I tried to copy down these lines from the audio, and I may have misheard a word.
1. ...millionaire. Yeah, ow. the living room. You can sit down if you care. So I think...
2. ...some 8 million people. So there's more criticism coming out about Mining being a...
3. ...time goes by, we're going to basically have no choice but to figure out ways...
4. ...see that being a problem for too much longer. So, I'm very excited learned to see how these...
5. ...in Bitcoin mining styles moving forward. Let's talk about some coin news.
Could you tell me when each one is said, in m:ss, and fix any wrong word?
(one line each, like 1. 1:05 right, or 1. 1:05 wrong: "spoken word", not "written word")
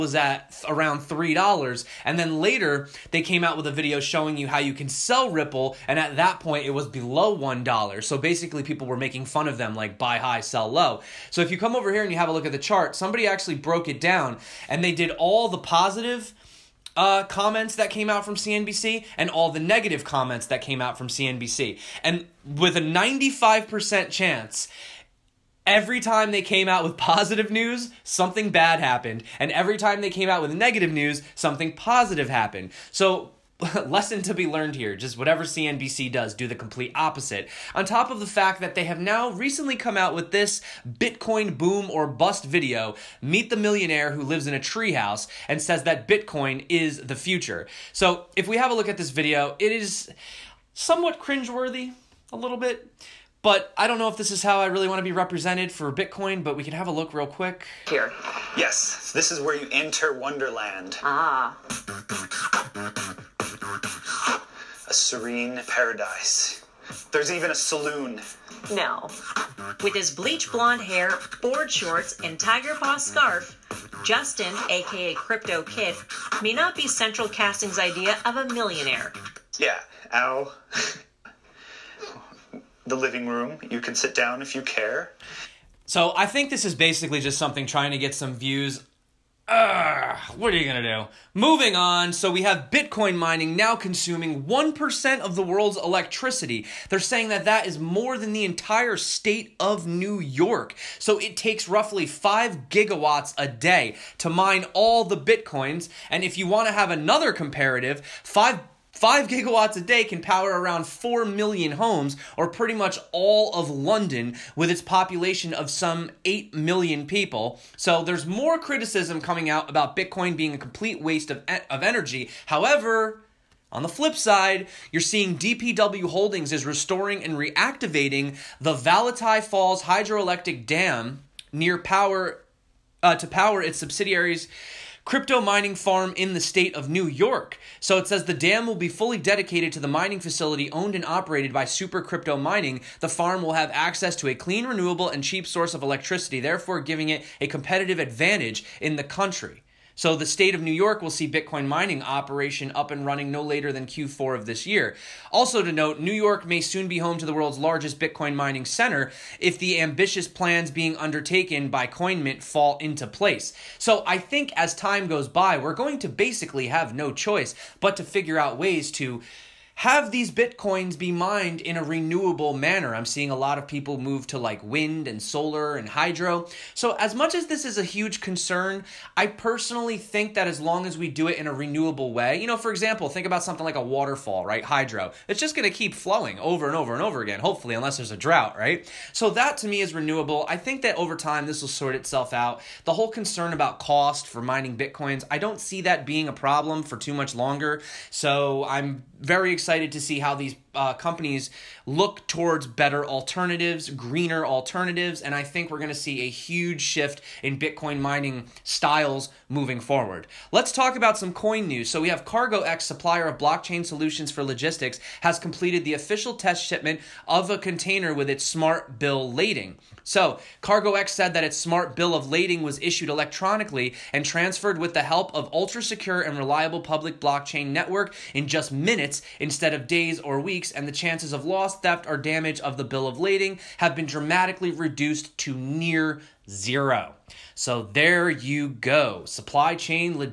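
1. 1:18 right
2. 1:55 wrong: "Bitcoin", not "Mining"
3. 2:44 right
4. 3:15 wrong: "excited", not "learned"
5. 3:27 right.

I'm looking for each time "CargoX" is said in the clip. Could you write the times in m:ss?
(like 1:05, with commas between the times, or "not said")
3:32, 3:40.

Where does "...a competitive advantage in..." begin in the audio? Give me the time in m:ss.
2:27.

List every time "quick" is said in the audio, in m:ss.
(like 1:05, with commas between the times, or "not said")
0:57.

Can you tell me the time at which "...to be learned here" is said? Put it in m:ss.
0:34.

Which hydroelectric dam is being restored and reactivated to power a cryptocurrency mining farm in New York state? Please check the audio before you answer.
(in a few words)
Valatie Falls.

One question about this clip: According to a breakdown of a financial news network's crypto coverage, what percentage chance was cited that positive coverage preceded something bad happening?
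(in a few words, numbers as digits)
95%.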